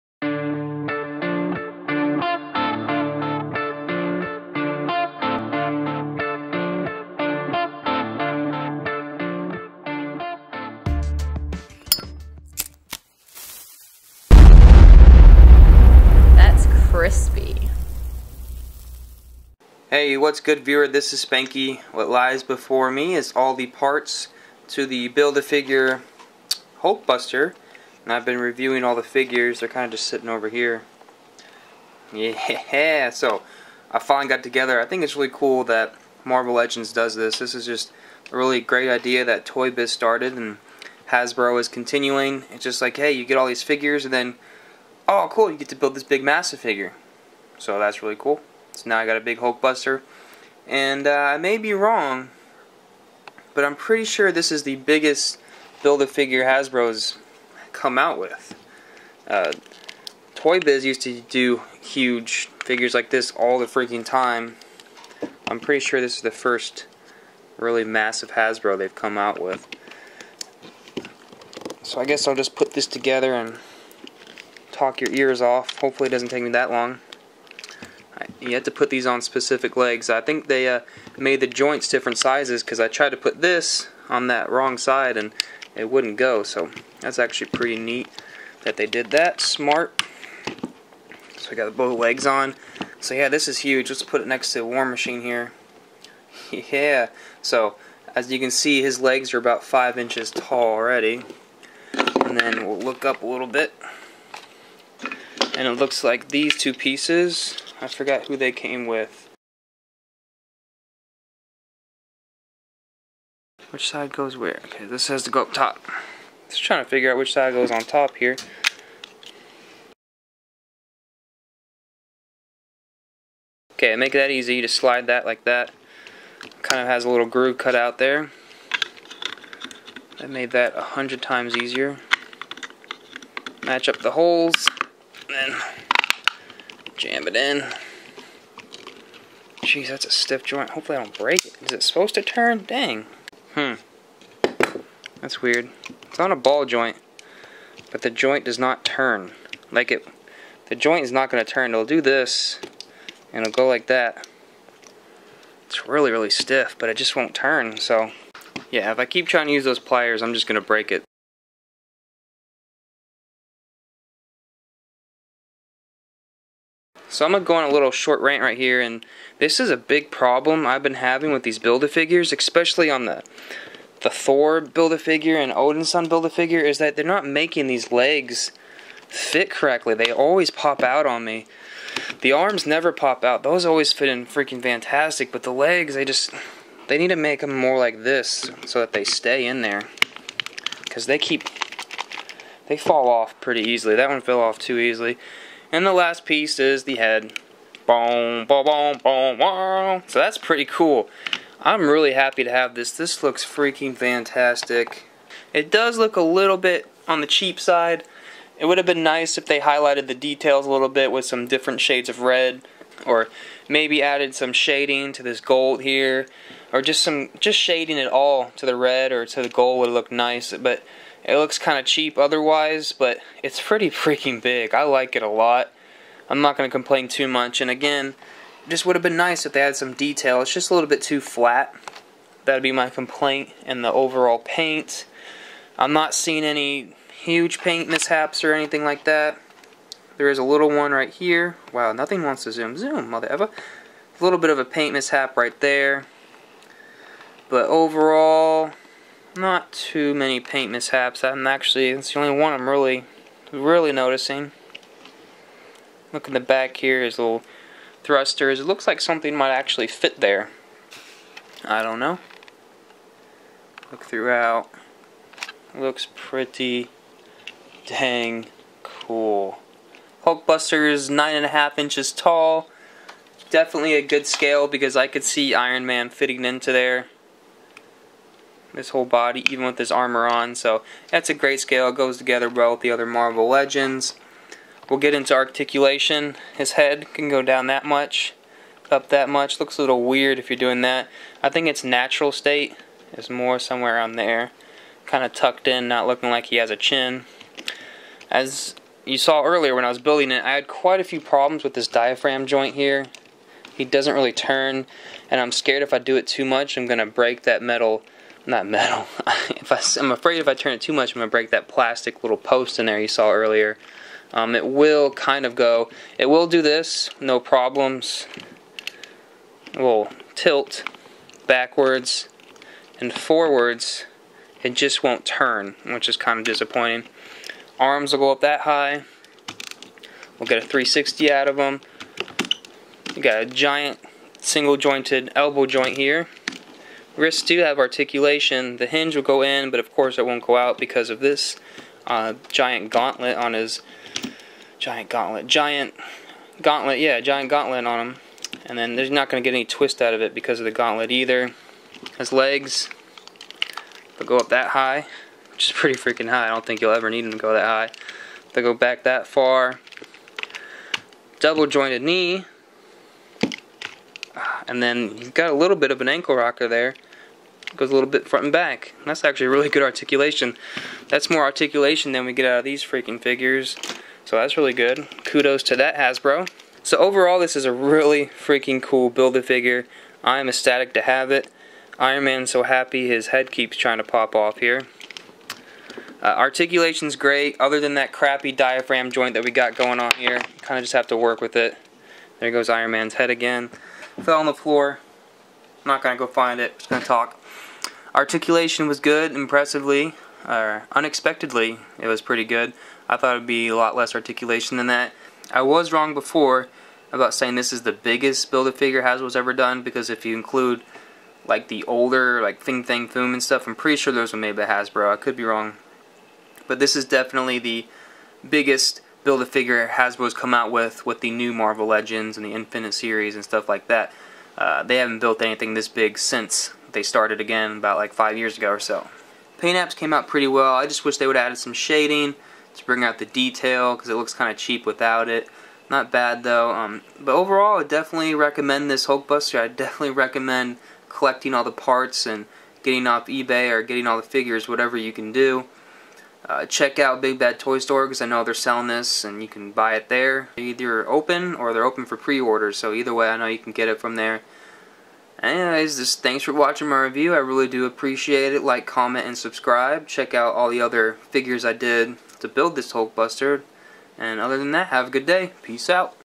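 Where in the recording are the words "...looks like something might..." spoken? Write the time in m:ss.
4:18.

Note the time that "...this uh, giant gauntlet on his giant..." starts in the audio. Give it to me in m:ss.
5:41.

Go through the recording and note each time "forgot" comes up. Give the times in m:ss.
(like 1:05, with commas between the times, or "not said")
1:47.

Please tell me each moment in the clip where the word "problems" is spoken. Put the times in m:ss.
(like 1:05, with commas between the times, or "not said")
2:50, 5:01, 5:17.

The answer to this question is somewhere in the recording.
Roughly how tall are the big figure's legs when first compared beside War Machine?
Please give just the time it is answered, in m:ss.
1:39.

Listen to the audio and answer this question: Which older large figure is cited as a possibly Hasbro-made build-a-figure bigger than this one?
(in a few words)
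Fin Fang Foom.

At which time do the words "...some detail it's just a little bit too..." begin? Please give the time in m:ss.
3:49.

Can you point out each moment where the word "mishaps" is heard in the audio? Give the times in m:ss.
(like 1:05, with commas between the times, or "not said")
3:57, 4:04, 4:10.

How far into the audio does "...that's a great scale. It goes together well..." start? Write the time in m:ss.
4:41.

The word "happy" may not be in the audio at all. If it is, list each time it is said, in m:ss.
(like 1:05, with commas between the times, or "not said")
3:22, 6:22.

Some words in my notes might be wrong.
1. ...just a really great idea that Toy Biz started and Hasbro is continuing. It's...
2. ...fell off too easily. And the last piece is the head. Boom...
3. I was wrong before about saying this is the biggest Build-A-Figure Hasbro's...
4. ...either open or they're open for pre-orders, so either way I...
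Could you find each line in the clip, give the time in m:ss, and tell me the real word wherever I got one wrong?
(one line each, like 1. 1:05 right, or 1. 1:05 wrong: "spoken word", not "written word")
1. 0:37 right
2. 3:14 right
3. 6:45 right
4. 7:30 right.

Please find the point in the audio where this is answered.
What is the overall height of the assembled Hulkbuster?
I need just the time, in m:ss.
4:31.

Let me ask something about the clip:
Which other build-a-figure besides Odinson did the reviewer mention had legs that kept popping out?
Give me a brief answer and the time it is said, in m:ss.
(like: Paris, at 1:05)
Thor, at 2:54.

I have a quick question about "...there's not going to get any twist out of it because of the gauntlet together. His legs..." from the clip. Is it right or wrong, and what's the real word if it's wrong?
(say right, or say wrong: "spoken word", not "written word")
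wrong: "either", not "together".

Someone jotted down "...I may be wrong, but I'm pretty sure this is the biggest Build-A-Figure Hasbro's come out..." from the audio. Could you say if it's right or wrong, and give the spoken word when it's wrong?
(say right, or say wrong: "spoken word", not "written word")
right.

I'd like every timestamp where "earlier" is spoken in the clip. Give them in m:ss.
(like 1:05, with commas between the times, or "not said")
4:59, 5:13.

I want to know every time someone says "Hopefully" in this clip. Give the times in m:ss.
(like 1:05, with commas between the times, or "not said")
1:15, 2:20.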